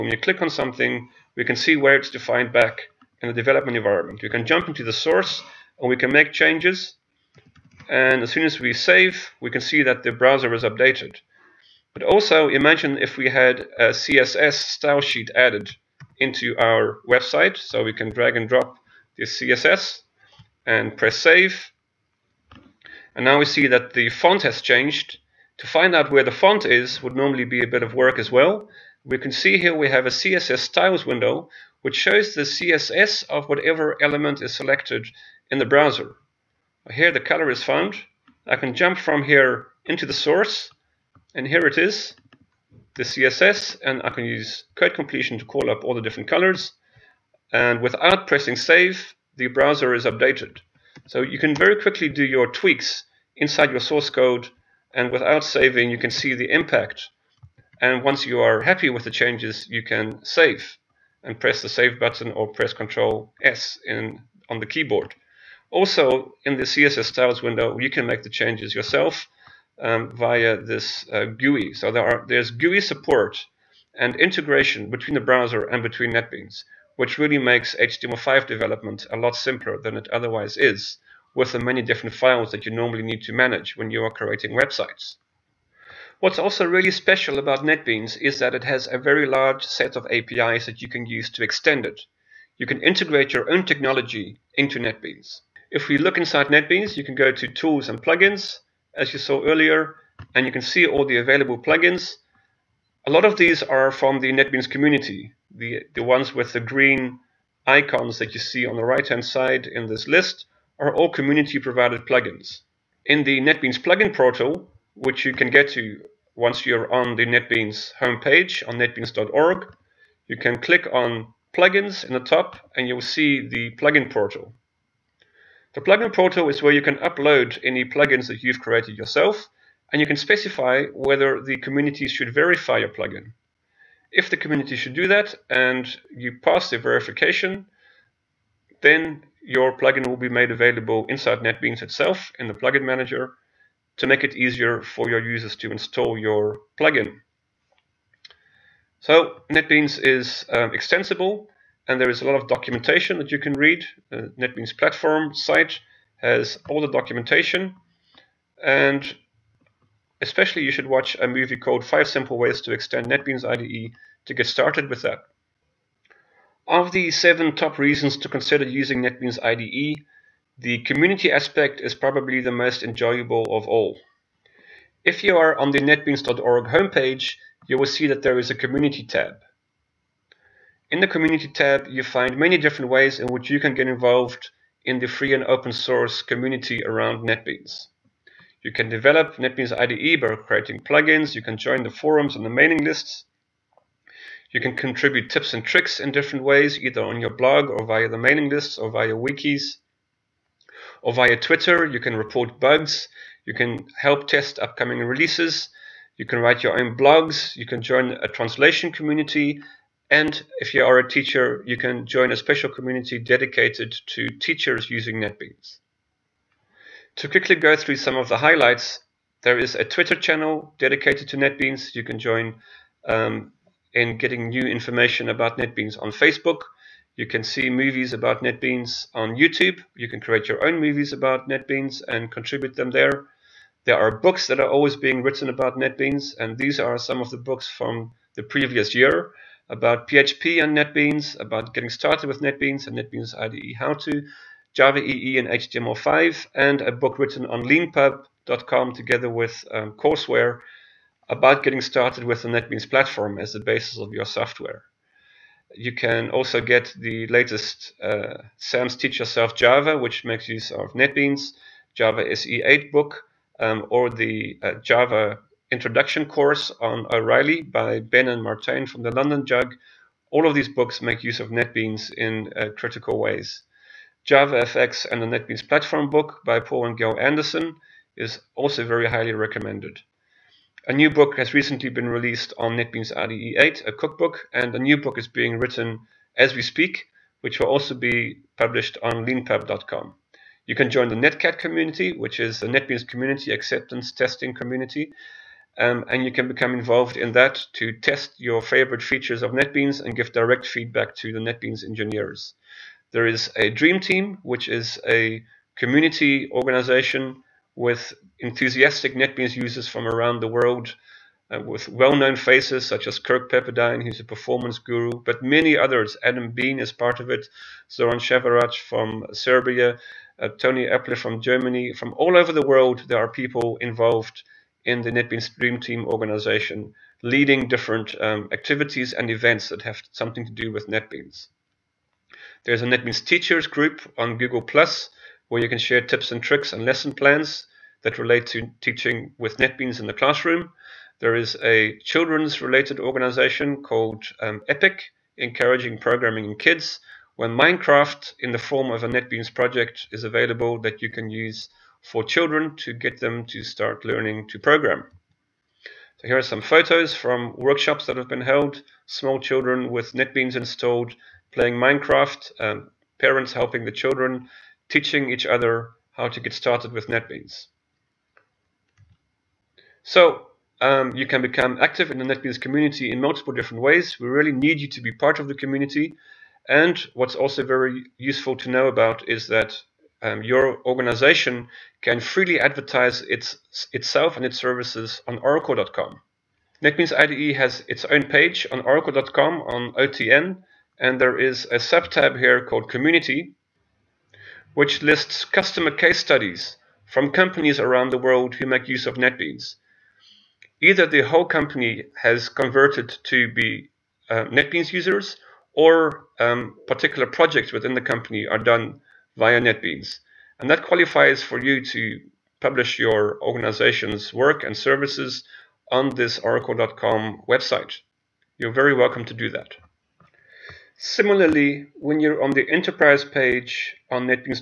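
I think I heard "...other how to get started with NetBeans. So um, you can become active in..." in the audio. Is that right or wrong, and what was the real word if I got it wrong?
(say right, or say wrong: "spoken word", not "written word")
right.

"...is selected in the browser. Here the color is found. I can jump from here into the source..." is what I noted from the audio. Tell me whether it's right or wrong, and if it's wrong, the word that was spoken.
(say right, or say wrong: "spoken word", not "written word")
right.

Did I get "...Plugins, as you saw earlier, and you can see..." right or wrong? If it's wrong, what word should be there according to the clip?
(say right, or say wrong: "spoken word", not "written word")
right.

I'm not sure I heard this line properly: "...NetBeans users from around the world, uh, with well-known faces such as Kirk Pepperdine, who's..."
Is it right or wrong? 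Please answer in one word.
right.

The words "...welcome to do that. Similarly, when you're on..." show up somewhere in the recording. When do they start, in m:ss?
6:58.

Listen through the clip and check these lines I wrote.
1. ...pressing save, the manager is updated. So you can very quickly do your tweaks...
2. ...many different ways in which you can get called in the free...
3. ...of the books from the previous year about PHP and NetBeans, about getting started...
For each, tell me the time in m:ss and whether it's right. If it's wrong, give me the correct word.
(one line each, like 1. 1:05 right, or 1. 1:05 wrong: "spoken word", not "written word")
1. 0:48 wrong: "browser", not "manager"
2. 3:02 wrong: "involved", not "called"
3. 3:57 right.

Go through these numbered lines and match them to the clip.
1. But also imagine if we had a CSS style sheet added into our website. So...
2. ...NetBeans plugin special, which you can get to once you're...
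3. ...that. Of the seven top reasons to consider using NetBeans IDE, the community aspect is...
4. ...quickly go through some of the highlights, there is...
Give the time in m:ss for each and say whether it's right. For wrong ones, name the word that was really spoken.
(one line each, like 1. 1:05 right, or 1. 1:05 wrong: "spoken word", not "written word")
1. 0:11 right
2. 1:53 wrong: "portal", not "special"
3. 2:45 right
4. 3:37 right.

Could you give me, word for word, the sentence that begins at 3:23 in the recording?
You can help test upcoming releases.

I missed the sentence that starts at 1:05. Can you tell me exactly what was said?
Also, in the CSS styles window, you can make the changes yourself um, via this uh, GUI.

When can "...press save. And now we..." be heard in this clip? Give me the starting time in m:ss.
0:20.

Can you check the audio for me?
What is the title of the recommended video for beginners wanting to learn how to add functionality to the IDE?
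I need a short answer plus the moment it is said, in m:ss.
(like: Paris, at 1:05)
Five Simple Ways to Extend NetBeans IDE, at 2:41.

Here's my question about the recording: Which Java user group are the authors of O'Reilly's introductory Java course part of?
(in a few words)
London JUG.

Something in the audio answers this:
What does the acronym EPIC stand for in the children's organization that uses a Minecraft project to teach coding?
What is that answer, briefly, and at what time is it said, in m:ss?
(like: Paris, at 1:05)
Encouraging Programming in Kids, at 5:45.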